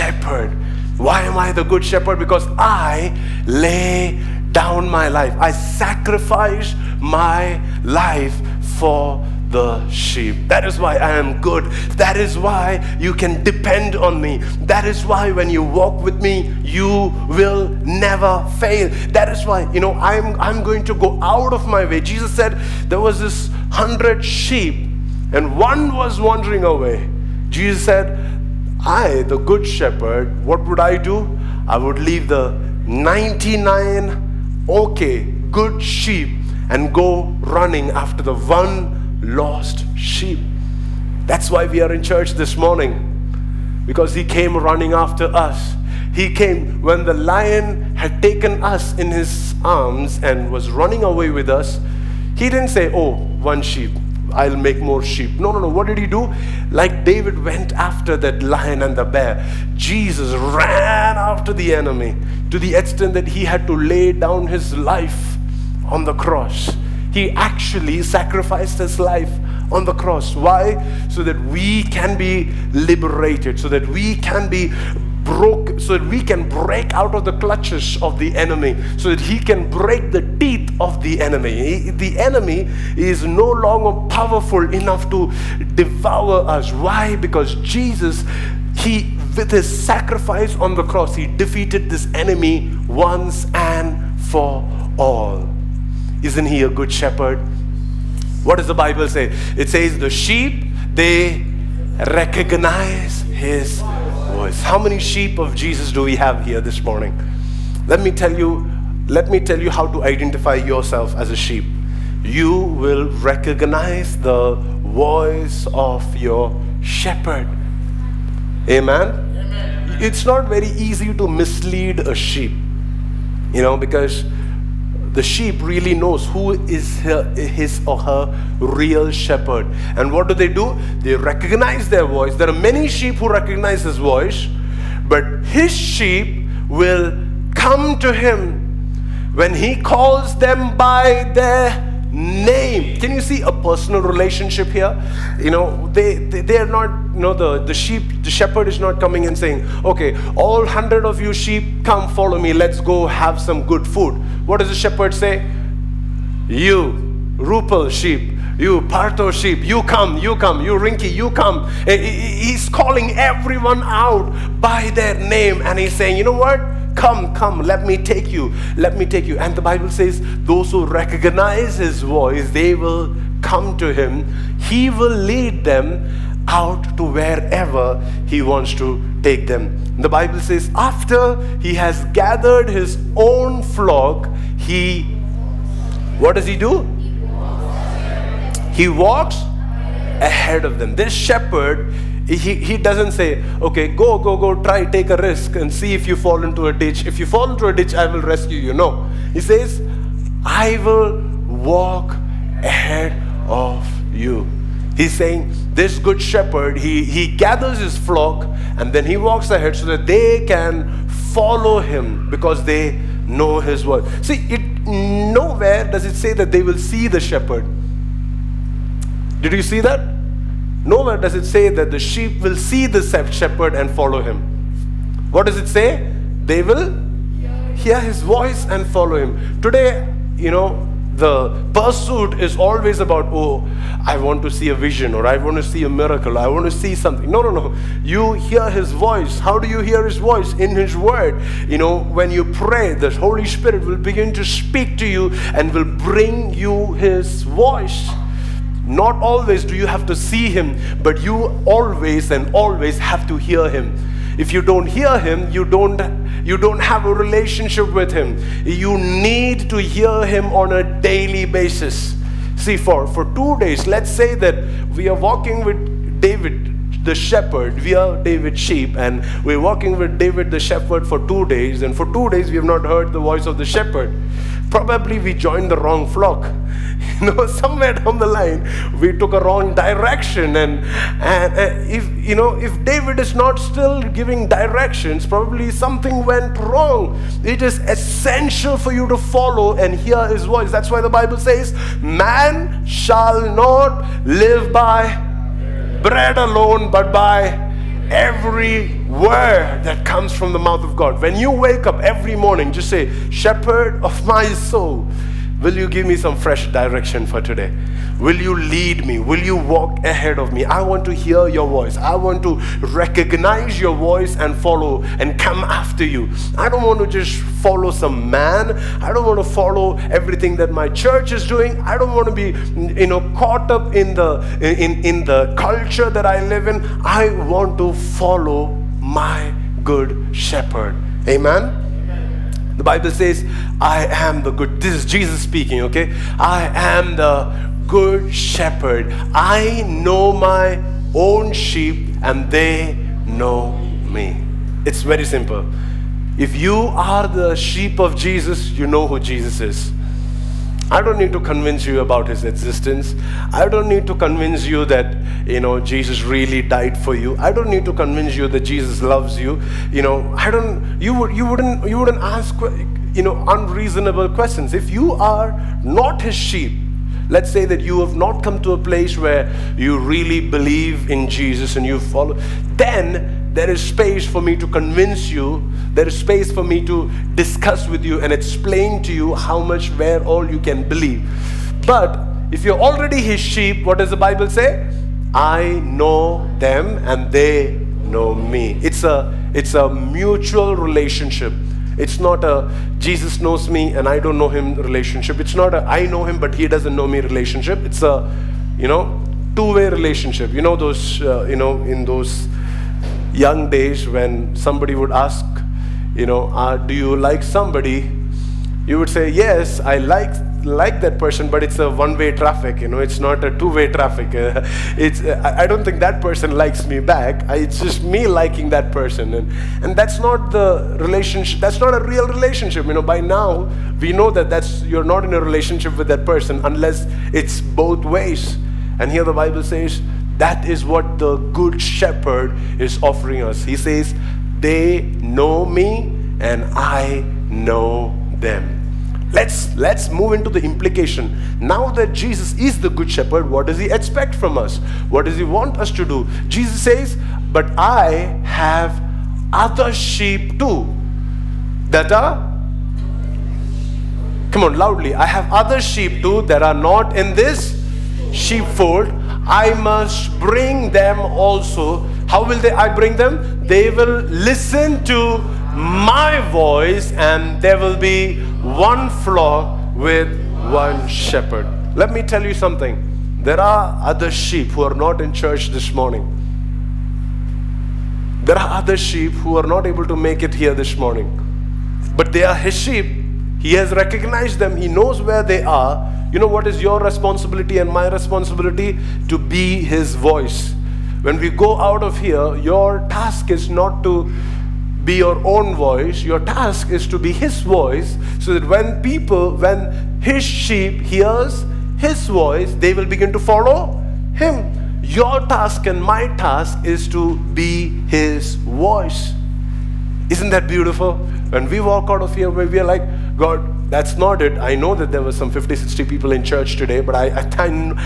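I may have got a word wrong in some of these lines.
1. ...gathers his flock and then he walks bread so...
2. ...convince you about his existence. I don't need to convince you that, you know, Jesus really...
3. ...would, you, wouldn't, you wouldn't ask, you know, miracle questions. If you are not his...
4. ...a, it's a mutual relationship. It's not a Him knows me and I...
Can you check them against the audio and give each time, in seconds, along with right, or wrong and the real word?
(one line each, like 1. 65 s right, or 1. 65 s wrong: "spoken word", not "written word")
1. 207 s wrong: "ahead", not "bread"
2. 351 s right
3. 361 s wrong: "unreasonable", not "miracle"
4. 389 s wrong: "Jesus", not "Him".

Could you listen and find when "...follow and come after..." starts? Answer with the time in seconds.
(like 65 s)
314 s.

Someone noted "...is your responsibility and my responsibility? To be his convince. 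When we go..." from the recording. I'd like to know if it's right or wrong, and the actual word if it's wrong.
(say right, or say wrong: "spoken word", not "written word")
wrong: "voice", not "convince".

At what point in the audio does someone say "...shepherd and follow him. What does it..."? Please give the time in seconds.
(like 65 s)
223 s.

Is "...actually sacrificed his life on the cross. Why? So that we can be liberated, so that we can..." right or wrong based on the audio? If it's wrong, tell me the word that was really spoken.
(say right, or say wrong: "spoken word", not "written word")
right.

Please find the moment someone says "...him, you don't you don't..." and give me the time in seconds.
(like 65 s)
255 s.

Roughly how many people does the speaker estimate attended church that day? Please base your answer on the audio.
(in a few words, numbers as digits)
50 to 60.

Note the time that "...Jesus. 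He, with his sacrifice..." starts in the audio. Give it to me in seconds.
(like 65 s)
87 s.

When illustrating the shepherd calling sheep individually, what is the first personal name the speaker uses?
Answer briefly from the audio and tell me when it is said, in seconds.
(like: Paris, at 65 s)
Rupal, at 157 s.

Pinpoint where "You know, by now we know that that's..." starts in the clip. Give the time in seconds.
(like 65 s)
422 s.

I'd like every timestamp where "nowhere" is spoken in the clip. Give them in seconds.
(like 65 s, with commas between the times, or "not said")
214 s, 220 s.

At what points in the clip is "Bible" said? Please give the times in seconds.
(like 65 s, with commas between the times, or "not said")
98 s, 169 s, 180 s, 291 s, 332 s, 384 s, 429 s.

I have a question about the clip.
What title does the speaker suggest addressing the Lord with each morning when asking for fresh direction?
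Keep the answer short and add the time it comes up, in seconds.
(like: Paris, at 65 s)
Shepherd of my soul, at 303 s.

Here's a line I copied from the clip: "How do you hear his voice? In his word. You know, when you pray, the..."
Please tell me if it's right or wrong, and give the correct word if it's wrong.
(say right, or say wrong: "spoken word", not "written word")
right.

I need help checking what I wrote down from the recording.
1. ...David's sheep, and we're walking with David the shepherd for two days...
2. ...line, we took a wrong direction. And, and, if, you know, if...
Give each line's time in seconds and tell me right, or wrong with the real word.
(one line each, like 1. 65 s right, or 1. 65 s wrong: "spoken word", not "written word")
1. 268 s right
2. 278 s right.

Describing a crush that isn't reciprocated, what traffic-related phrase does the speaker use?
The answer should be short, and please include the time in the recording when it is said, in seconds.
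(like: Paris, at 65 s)
one-way traffic, at 411 s.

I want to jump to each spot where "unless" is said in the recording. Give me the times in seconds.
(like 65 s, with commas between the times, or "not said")
426 s.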